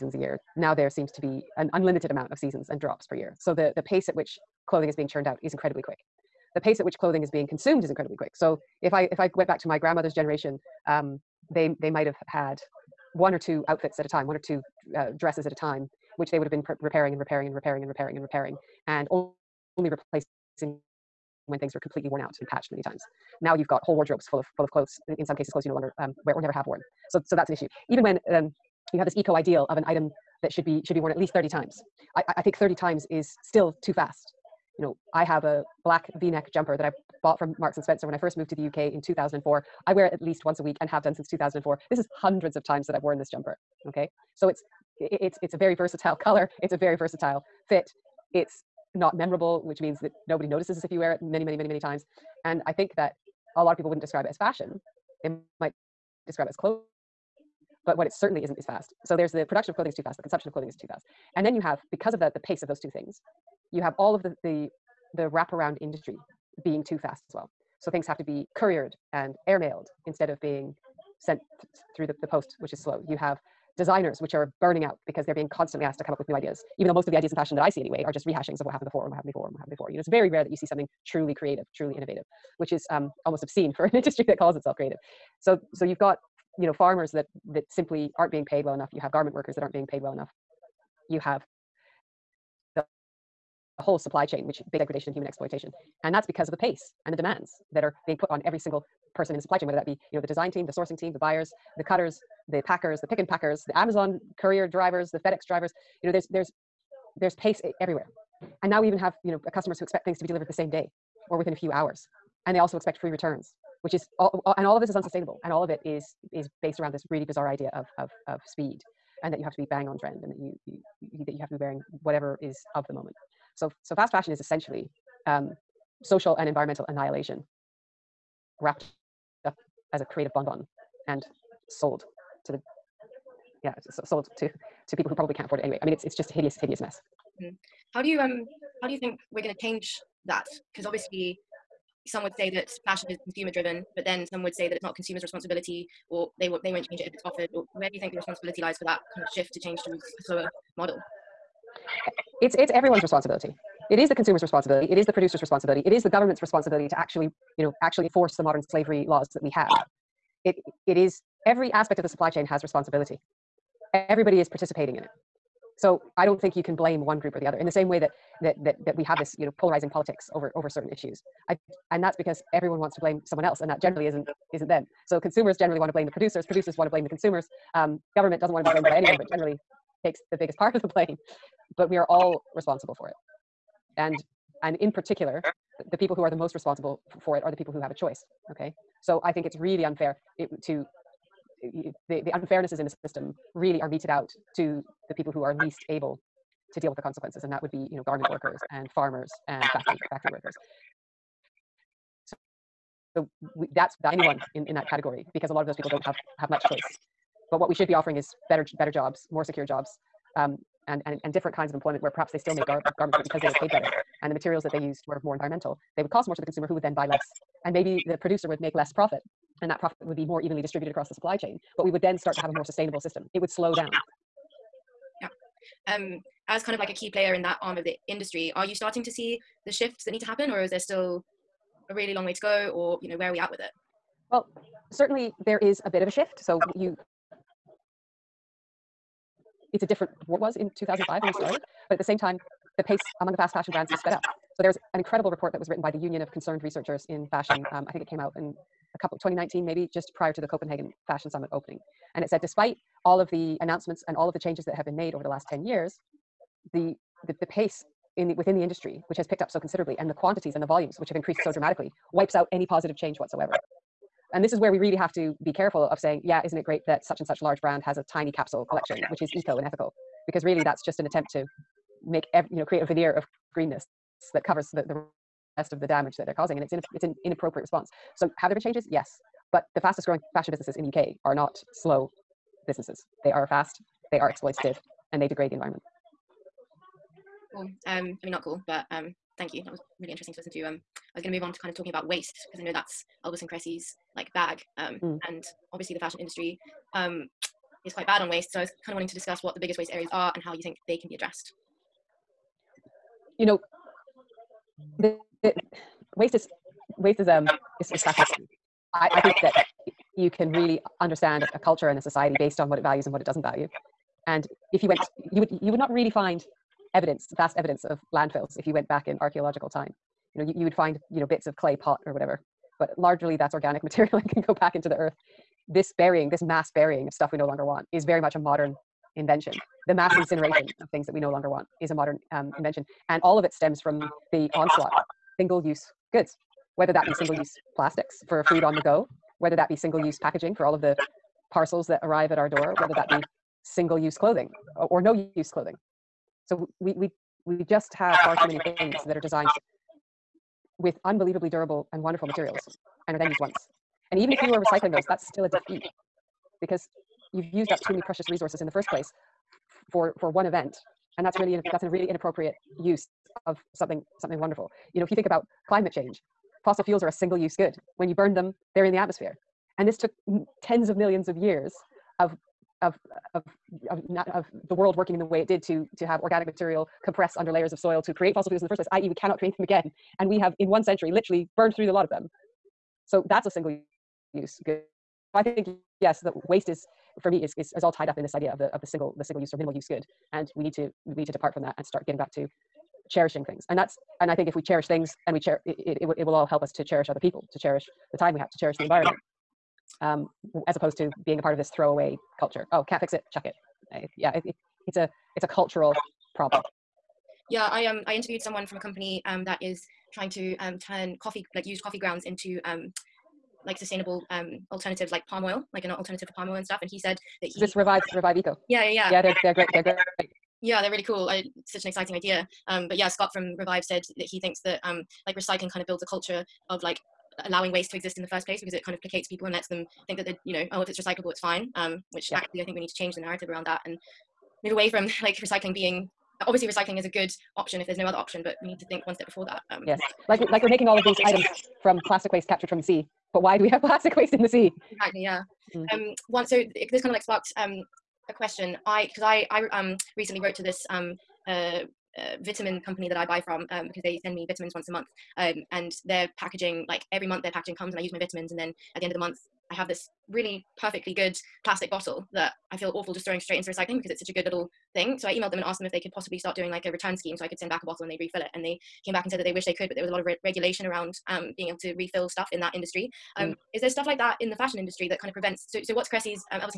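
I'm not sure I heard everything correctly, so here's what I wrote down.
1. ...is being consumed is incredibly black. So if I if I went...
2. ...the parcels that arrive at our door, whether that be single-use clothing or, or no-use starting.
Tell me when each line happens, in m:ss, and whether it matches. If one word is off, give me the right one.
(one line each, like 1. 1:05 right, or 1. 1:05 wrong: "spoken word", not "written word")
1. 0:07 wrong: "quick", not "black"
2. 5:40 wrong: "clothing", not "starting".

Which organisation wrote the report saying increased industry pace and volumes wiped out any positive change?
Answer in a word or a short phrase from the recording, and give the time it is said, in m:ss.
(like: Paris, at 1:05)
Union of Concerned Researchers in Fashion, at 4:05.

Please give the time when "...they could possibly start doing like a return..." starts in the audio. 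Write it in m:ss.
7:45.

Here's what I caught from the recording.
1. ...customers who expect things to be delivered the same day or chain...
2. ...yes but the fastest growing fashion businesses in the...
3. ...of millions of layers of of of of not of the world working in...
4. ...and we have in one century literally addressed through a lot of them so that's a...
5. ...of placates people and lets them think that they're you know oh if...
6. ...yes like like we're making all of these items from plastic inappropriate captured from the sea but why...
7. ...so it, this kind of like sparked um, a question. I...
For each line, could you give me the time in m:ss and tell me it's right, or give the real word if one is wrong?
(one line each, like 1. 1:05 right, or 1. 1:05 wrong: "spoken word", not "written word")
1. 1:49 wrong: "within", not "chain"
2. 4:38 right
3. 6:10 wrong: "years", not "layers"
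4. 6:20 wrong: "burned", not "addressed"
5. 7:08 right
6. 7:19 wrong: "waste", not "inappropriate"
7. 7:26 right.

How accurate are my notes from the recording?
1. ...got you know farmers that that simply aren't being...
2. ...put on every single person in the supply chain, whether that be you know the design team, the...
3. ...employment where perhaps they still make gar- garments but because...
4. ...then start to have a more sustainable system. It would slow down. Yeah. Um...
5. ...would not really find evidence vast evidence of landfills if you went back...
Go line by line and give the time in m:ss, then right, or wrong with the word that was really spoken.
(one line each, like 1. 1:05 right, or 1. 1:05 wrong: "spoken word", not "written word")
1. 1:25 right
2. 1:38 right
3. 3:31 right
4. 3:42 right
5. 5:15 right.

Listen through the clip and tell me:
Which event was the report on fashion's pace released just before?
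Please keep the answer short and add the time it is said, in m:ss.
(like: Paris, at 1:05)
Copenhagen Fashion Summit, at 4:10.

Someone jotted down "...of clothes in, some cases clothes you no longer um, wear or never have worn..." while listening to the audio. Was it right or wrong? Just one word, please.
right.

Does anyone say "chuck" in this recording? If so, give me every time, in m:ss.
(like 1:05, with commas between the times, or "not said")
6:43.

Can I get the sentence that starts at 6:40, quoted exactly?
Um, as opposed to being a part of this throwaway culture.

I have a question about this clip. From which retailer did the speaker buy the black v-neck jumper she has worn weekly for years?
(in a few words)
Marks and Spencer.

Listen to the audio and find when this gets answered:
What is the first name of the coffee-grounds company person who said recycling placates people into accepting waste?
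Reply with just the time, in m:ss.
7:03.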